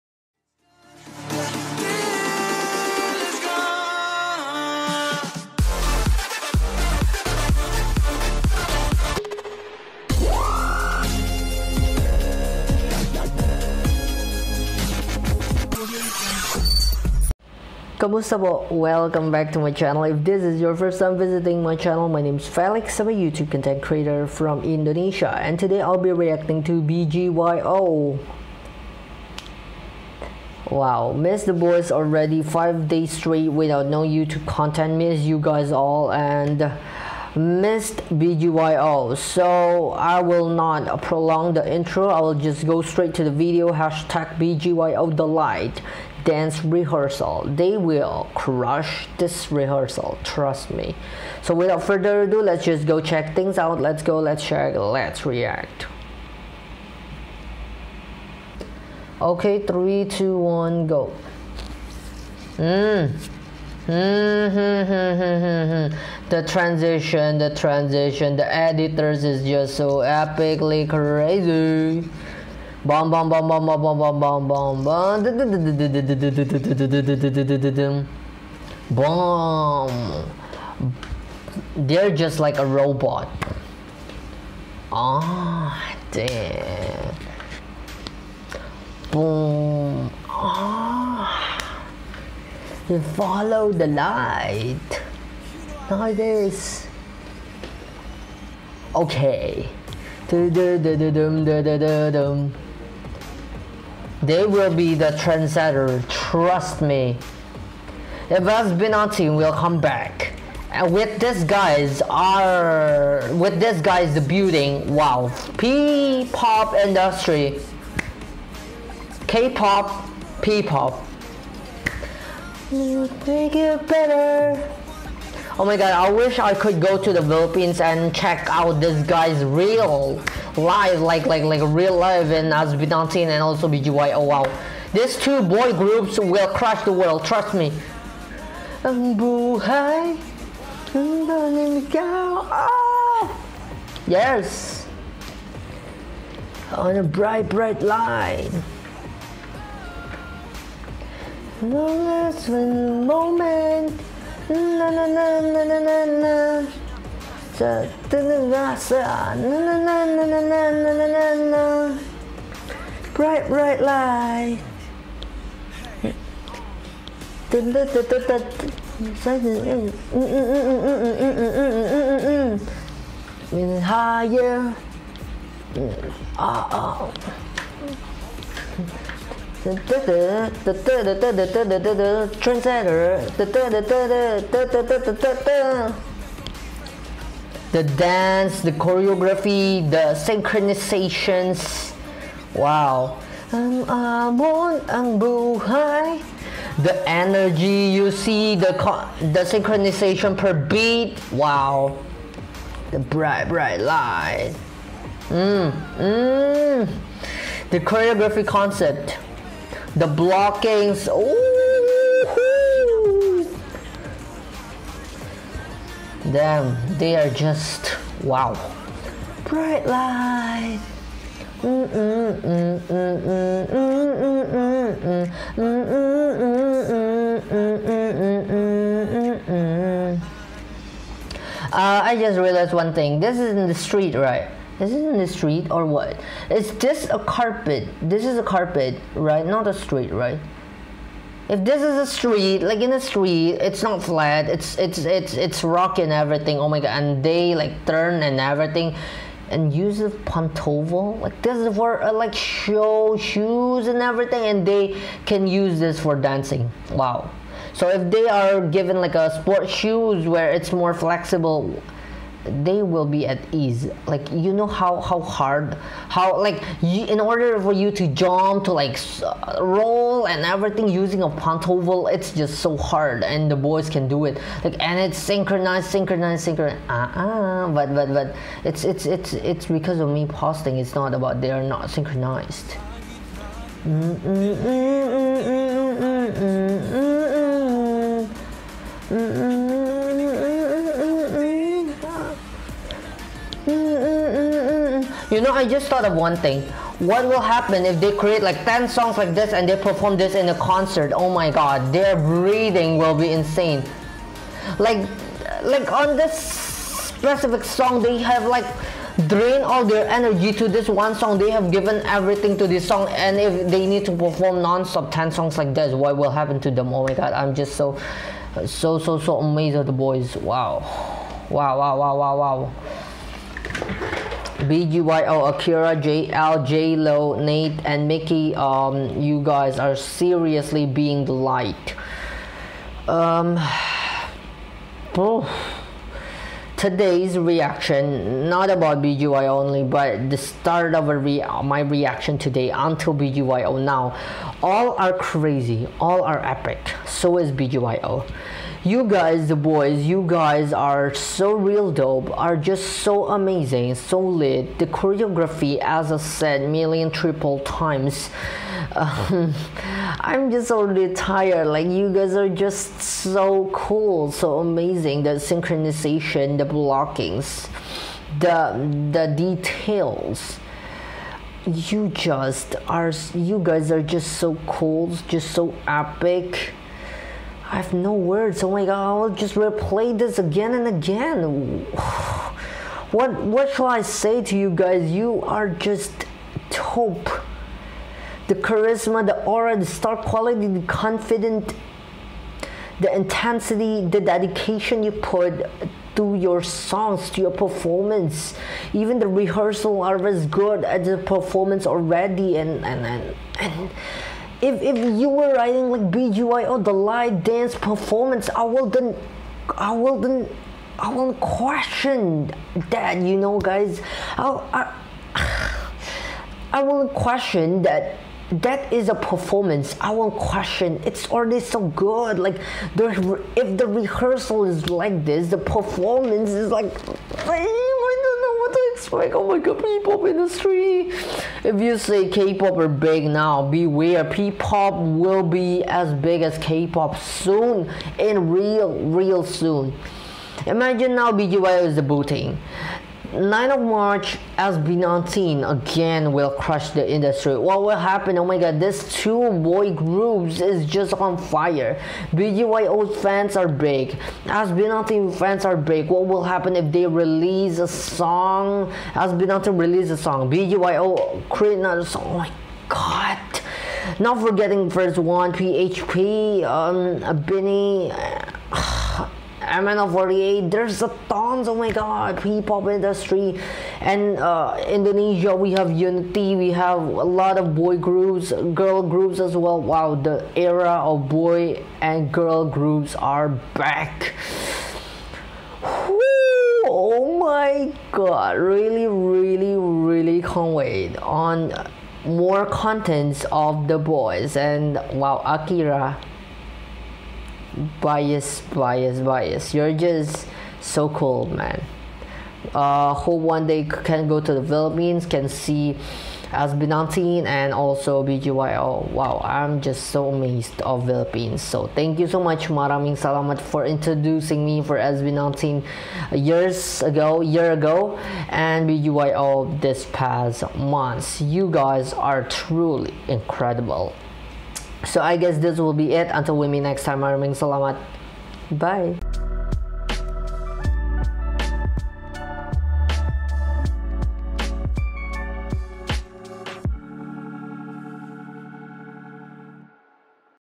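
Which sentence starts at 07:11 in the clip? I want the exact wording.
If you say K-pop are big now, beware, P-pop will be as big as K-pop soon, and real, real soon.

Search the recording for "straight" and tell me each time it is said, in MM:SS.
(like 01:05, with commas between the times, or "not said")
00:33, 00:42.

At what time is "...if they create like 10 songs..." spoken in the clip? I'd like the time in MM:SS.
04:57.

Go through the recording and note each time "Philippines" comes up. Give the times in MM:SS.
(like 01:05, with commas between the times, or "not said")
02:07, 08:24, 08:31.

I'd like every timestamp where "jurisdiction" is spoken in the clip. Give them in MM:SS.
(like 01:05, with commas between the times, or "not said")
not said.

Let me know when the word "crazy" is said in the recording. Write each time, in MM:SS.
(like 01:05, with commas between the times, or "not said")
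01:10, 05:45.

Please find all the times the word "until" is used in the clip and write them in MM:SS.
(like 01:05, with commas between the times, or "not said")
05:42, 08:46.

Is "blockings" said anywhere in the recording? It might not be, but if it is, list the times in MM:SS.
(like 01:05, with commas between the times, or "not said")
03:30, 06:06.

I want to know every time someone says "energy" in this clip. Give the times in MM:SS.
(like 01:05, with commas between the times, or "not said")
03:17, 05:10.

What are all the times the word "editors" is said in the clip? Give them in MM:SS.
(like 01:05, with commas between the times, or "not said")
01:08.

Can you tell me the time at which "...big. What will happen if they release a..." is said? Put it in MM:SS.
07:35.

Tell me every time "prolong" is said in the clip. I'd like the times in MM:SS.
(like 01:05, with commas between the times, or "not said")
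00:41.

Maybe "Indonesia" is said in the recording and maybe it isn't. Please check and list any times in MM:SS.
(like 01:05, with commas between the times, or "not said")
00:24, 07:54.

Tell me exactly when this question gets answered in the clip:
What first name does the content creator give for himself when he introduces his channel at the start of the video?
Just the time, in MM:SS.
00:22.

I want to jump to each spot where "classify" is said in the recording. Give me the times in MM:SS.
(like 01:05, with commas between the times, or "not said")
not said.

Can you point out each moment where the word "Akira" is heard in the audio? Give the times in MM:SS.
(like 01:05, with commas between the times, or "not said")
05:25, 08:15.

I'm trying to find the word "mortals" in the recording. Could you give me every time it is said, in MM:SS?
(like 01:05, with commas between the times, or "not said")
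not said.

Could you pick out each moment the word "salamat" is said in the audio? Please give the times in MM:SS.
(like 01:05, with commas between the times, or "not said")
08:33, 08:47.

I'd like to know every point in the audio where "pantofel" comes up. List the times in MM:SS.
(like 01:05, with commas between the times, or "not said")
04:10, 04:31.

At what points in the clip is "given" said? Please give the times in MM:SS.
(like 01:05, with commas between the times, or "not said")
04:18, 05:11.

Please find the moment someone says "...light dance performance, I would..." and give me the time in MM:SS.
06:46.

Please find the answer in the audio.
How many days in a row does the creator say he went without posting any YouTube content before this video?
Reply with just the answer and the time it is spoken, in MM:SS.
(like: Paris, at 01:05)
5, at 00:32.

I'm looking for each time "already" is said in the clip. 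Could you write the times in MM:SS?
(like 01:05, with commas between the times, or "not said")
00:31, 06:00, 06:41, 07:01.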